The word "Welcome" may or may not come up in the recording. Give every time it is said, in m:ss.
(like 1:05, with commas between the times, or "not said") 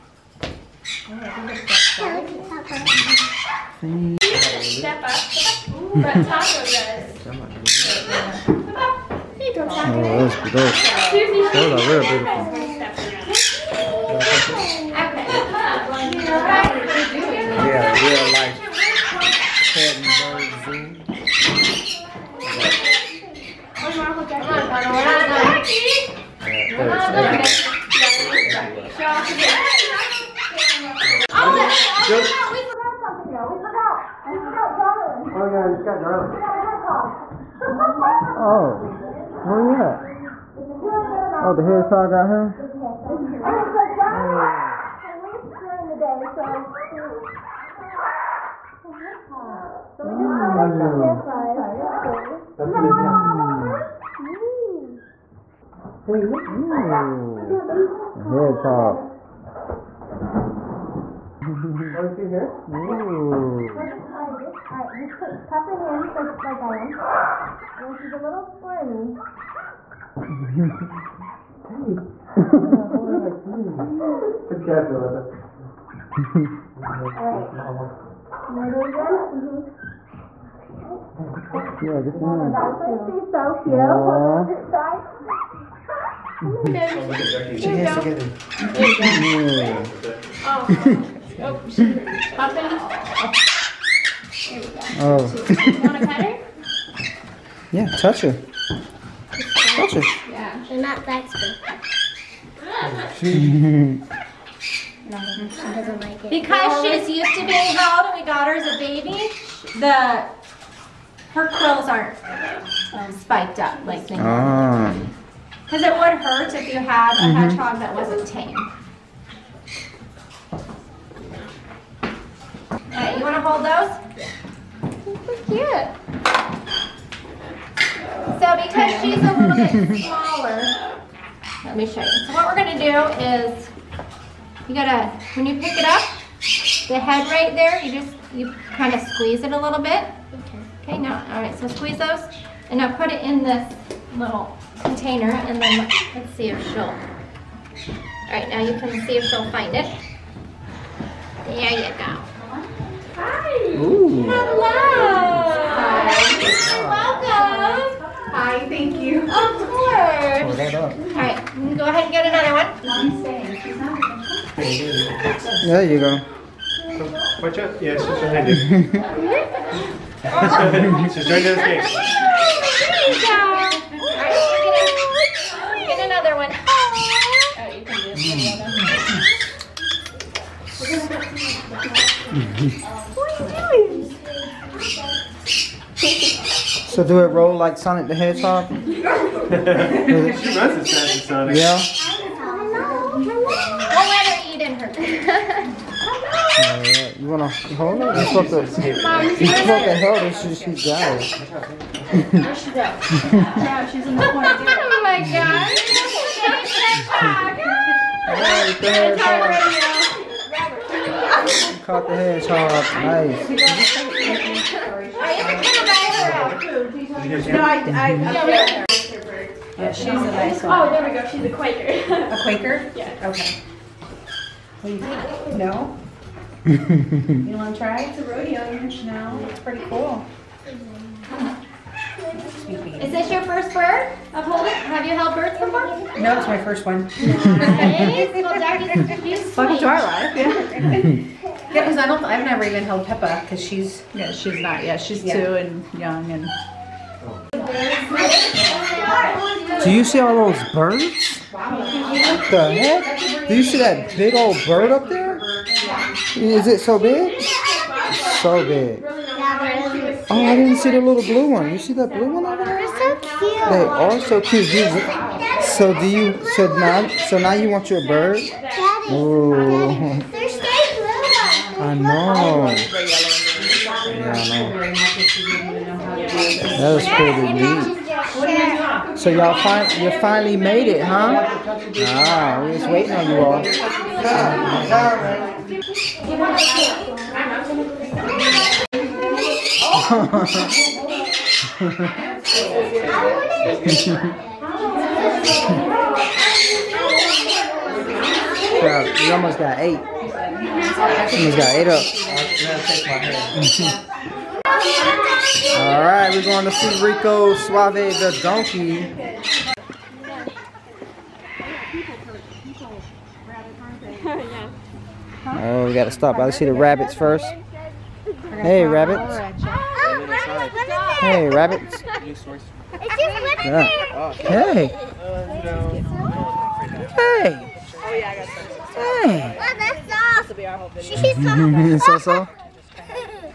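2:36, 3:57.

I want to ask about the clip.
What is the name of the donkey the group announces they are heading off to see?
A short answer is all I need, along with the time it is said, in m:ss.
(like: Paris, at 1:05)
Rico Suave, at 5:07.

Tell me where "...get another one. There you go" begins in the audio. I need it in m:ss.
2:42.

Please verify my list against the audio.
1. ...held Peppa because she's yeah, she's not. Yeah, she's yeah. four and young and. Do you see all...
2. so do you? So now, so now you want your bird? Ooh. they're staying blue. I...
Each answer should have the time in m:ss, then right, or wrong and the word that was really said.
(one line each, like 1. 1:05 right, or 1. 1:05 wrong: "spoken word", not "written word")
1. 4:02 wrong: "two", not "four"
2. 4:25 right.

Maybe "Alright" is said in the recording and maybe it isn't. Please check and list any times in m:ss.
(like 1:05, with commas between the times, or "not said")
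1:02, 1:12, 3:28.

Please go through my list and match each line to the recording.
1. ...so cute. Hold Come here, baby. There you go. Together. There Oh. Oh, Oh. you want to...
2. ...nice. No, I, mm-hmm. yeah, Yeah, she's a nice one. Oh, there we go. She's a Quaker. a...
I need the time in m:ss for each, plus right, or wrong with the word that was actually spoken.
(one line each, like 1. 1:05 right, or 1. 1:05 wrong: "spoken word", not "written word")
1. 1:23 right
2. 3:33 right.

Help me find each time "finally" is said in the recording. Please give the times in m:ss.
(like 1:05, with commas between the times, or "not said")
4:40.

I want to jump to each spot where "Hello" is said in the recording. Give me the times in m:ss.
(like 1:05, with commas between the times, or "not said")
2:34.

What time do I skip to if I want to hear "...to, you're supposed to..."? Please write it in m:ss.
3:18.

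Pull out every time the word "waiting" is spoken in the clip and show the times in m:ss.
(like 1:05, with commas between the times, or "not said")
4:42.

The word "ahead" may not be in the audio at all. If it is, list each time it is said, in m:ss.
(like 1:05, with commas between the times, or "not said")
2:41.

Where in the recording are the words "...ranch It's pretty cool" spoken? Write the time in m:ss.
3:48.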